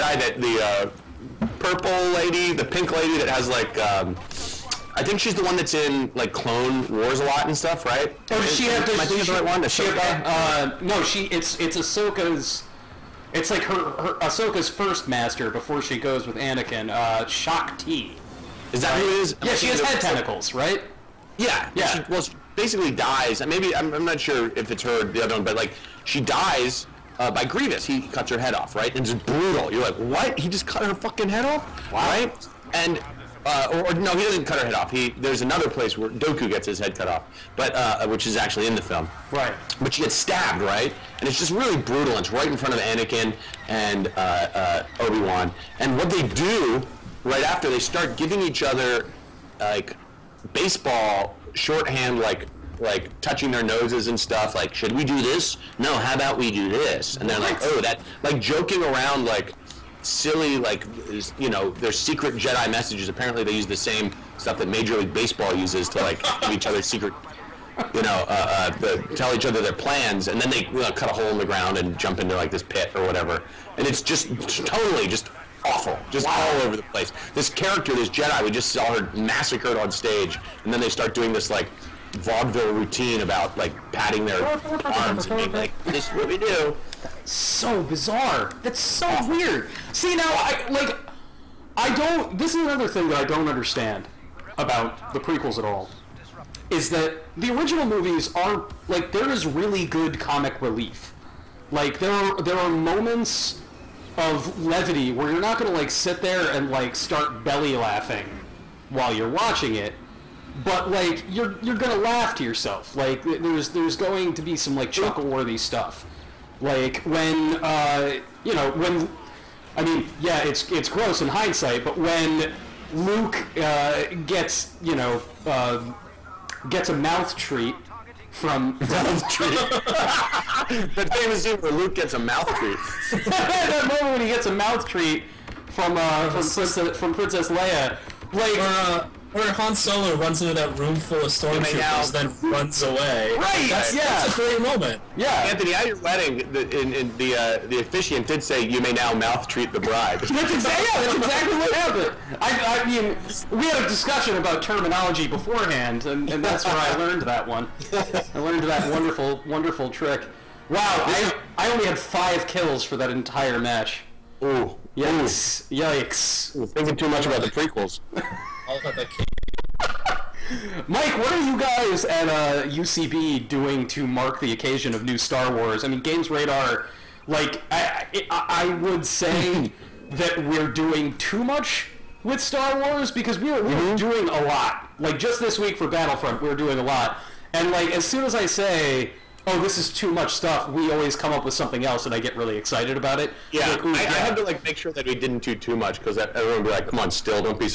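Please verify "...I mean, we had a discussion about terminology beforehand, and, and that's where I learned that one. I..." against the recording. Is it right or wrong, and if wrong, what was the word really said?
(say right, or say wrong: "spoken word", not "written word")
right.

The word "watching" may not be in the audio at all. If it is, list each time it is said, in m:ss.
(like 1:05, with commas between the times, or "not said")
1:49.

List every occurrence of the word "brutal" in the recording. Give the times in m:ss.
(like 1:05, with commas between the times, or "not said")
0:29, 0:41.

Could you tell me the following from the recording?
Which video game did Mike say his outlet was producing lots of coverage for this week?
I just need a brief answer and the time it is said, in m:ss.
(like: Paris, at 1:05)
Battlefront, at 3:05.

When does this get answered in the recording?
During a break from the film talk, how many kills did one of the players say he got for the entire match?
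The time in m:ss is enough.
2:41.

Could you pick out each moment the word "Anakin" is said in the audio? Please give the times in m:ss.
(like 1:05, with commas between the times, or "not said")
0:16, 0:42.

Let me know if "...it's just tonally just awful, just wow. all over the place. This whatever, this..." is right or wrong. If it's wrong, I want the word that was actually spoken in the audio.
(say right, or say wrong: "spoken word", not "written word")
wrong: "character", not "whatever".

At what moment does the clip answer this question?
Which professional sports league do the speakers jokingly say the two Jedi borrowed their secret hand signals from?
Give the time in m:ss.
1:04.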